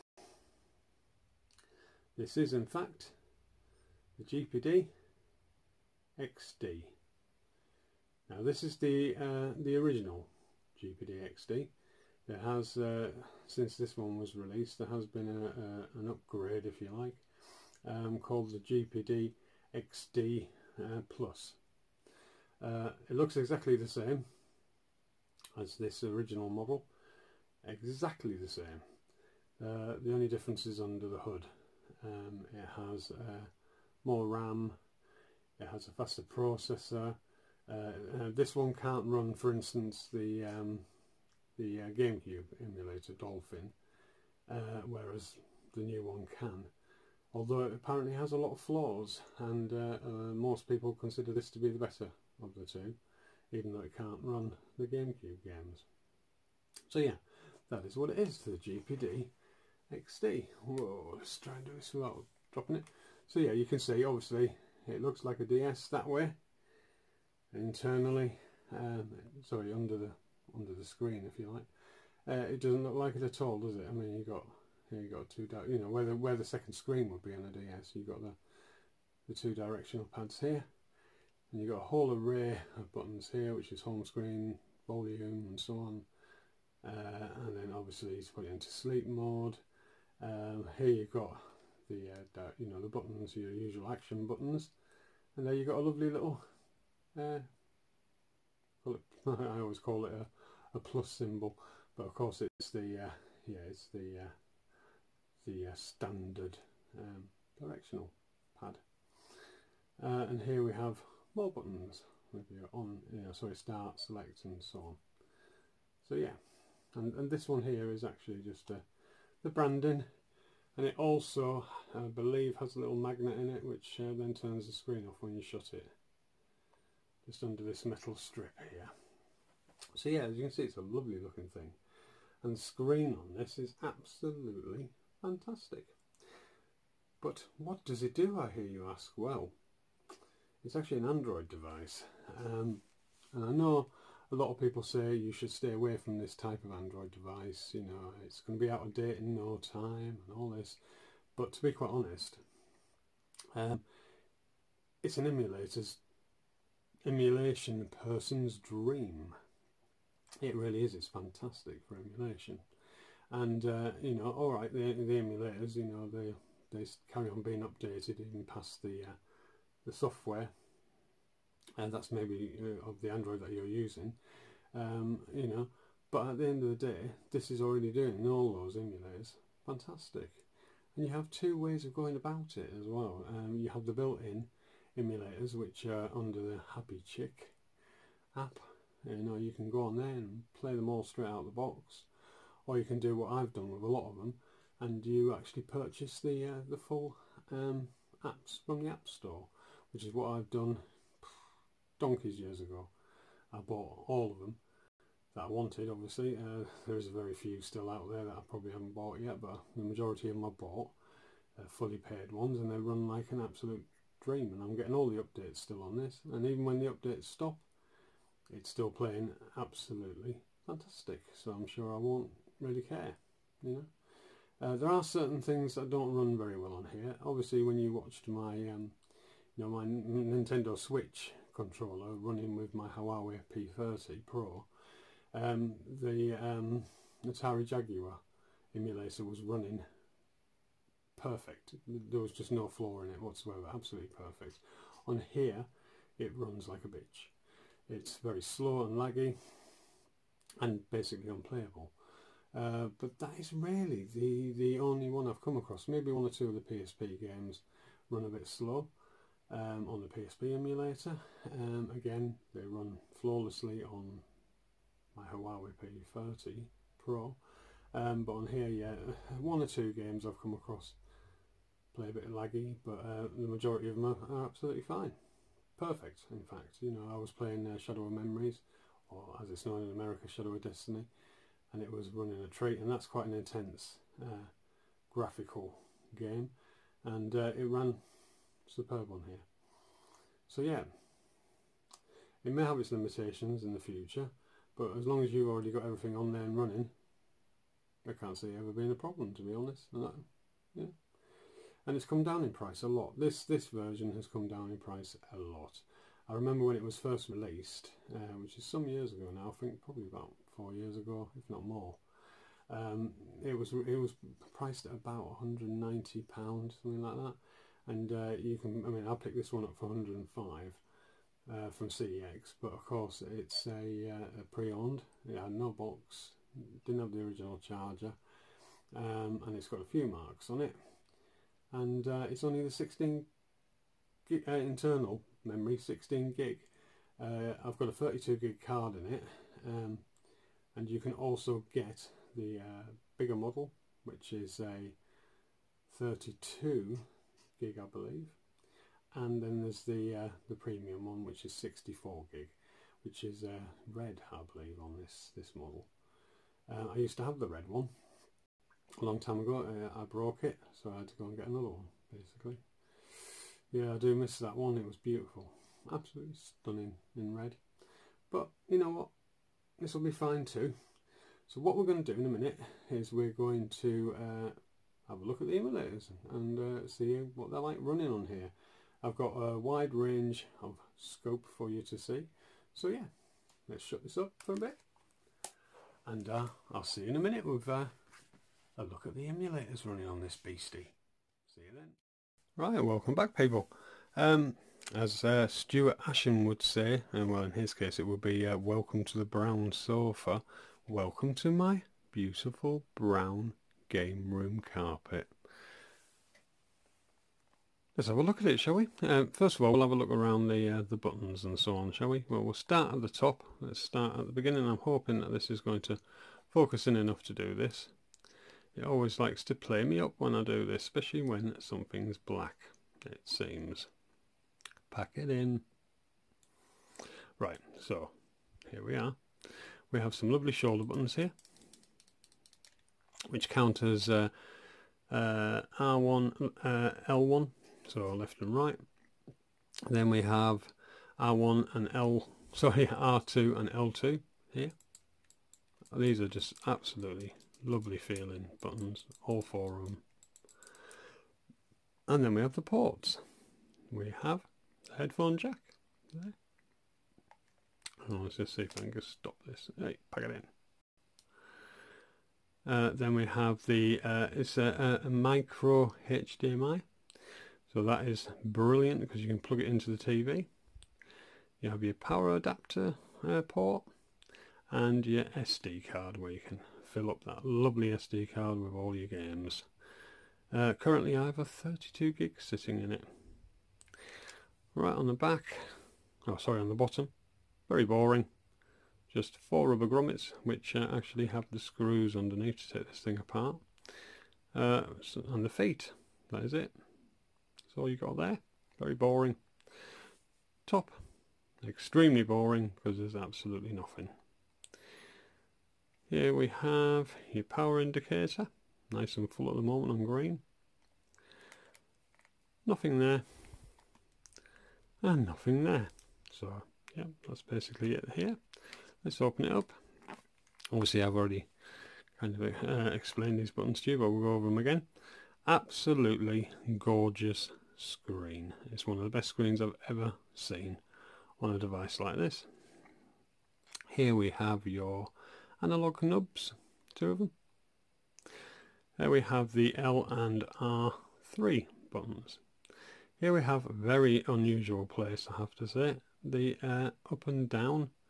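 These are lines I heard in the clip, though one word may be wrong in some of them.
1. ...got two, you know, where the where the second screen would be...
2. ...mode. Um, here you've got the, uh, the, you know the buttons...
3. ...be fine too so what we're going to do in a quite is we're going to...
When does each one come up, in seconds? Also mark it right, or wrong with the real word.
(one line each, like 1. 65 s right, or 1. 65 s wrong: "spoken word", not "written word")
1. 75 s right
2. 89 s right
3. 370 s wrong: "minute", not "quite".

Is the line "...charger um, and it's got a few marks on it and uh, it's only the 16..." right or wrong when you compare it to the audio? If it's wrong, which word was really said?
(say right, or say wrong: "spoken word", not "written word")
right.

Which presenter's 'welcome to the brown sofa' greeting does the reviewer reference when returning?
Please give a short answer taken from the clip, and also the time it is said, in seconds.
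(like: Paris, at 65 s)
Stuart Ashen, at 395 s.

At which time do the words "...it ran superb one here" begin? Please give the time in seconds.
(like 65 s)
287 s.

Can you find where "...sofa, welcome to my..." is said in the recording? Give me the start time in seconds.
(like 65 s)
399 s.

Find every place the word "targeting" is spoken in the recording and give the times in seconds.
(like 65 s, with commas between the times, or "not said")
not said.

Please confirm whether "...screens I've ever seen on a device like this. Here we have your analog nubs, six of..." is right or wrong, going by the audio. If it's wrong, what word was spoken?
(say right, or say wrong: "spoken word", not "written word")
wrong: "two", not "six".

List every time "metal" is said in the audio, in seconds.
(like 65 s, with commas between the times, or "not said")
127 s.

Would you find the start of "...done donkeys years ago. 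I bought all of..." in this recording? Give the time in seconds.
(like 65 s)
200 s.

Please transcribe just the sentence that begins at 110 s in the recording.
Uh, and here we have more buttons with your on, you know, sorry, start, select and so on.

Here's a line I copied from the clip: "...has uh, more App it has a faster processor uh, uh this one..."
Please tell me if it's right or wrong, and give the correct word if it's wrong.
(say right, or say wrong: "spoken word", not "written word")
wrong: "RAM", not "App".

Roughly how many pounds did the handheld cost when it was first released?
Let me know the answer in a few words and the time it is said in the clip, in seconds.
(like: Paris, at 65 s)
190 pounds, at 315 s.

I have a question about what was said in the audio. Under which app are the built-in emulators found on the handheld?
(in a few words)
Happy Chick.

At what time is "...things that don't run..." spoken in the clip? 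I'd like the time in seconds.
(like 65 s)
225 s.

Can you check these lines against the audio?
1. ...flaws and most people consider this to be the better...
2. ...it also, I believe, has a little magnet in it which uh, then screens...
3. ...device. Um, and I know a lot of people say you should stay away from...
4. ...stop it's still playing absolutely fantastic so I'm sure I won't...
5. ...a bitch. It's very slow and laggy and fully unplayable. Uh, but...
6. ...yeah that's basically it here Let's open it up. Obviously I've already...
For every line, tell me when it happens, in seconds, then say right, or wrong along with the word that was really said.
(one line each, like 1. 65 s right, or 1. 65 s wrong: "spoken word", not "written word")
1. 48 s right
2. 120 s wrong: "turns", not "screens"
3. 141 s right
4. 217 s right
5. 246 s wrong: "basically", not "fully"
6. 516 s right.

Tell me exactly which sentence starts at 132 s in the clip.
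And the screen on this is absolutely fantastic.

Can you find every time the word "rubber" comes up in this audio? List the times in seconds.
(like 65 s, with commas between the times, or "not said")
489 s.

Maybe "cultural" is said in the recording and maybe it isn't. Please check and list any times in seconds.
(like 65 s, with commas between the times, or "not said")
not said.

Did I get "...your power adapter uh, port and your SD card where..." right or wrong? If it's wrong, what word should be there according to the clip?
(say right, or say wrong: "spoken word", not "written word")
right.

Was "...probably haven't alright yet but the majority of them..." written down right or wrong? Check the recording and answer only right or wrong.
wrong.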